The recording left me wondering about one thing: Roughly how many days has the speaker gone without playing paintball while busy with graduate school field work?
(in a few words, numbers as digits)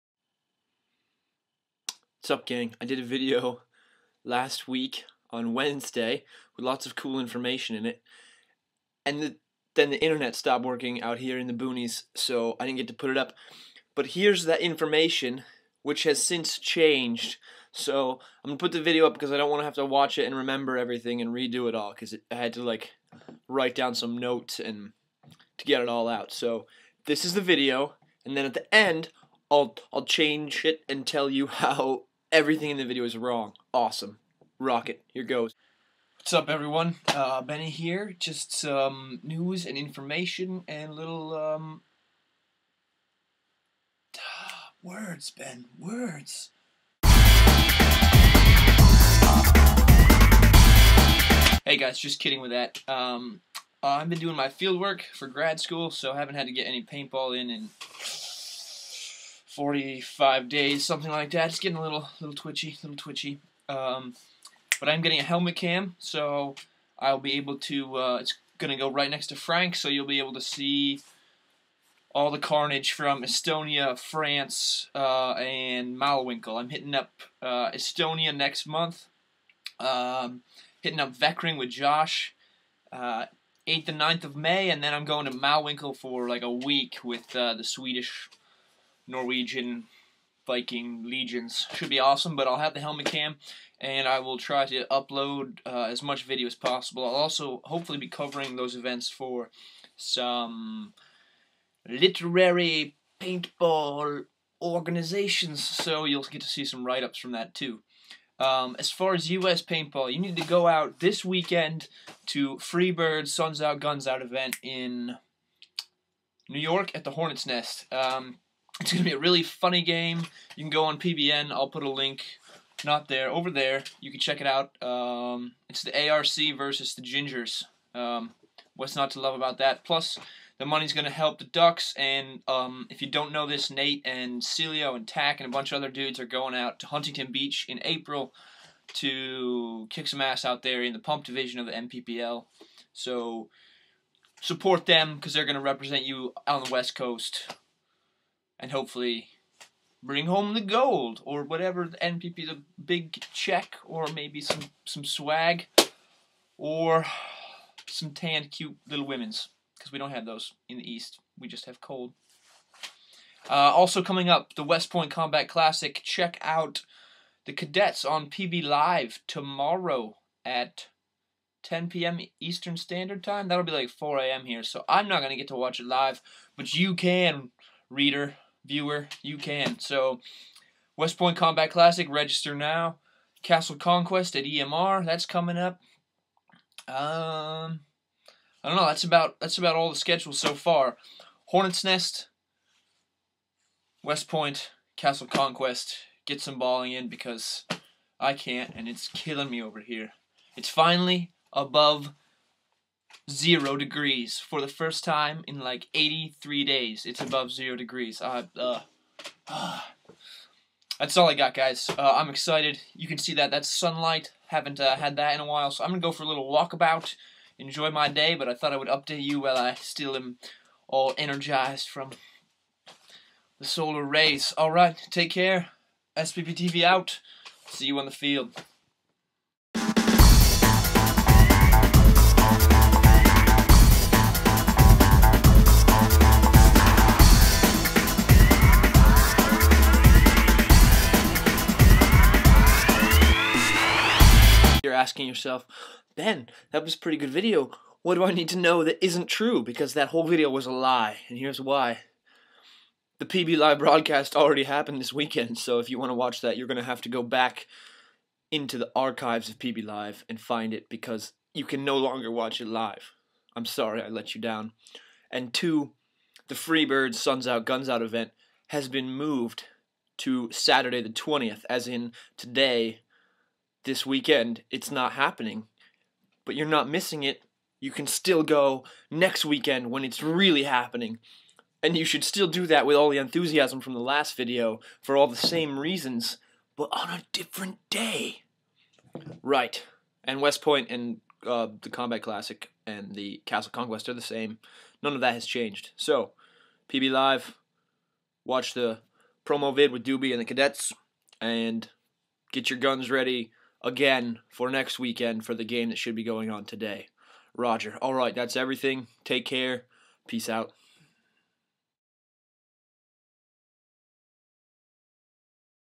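45.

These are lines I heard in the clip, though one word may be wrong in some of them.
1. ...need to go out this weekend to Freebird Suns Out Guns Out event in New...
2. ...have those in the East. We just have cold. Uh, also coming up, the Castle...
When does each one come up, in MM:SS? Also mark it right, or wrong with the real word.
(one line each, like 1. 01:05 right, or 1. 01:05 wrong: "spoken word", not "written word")
1. 01:50 right
2. 02:40 wrong: "West", not "Castle".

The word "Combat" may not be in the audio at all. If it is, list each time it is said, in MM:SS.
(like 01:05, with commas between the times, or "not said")
02:45, 03:01, 04:51.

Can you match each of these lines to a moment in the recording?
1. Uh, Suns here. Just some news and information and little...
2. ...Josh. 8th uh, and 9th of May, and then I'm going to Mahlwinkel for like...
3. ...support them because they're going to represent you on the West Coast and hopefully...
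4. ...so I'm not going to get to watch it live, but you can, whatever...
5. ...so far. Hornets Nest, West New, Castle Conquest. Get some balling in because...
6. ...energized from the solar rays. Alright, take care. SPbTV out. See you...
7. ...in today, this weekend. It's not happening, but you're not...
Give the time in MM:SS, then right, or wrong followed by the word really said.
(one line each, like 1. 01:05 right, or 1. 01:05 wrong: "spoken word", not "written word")
1. 00:37 wrong: "Benny", not "Suns"
2. 01:21 right
3. 02:24 right
4. 02:54 wrong: "reader", not "whatever"
5. 03:10 wrong: "Point", not "New"
6. 03:41 right
7. 04:31 right.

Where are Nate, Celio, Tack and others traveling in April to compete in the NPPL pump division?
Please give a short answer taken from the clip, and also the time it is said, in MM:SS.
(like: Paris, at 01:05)
Huntington Beach, at 02:16.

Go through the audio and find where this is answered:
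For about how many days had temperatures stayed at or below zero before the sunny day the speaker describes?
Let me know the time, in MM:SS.
03:25.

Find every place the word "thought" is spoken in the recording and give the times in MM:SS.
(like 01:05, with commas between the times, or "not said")
03:38.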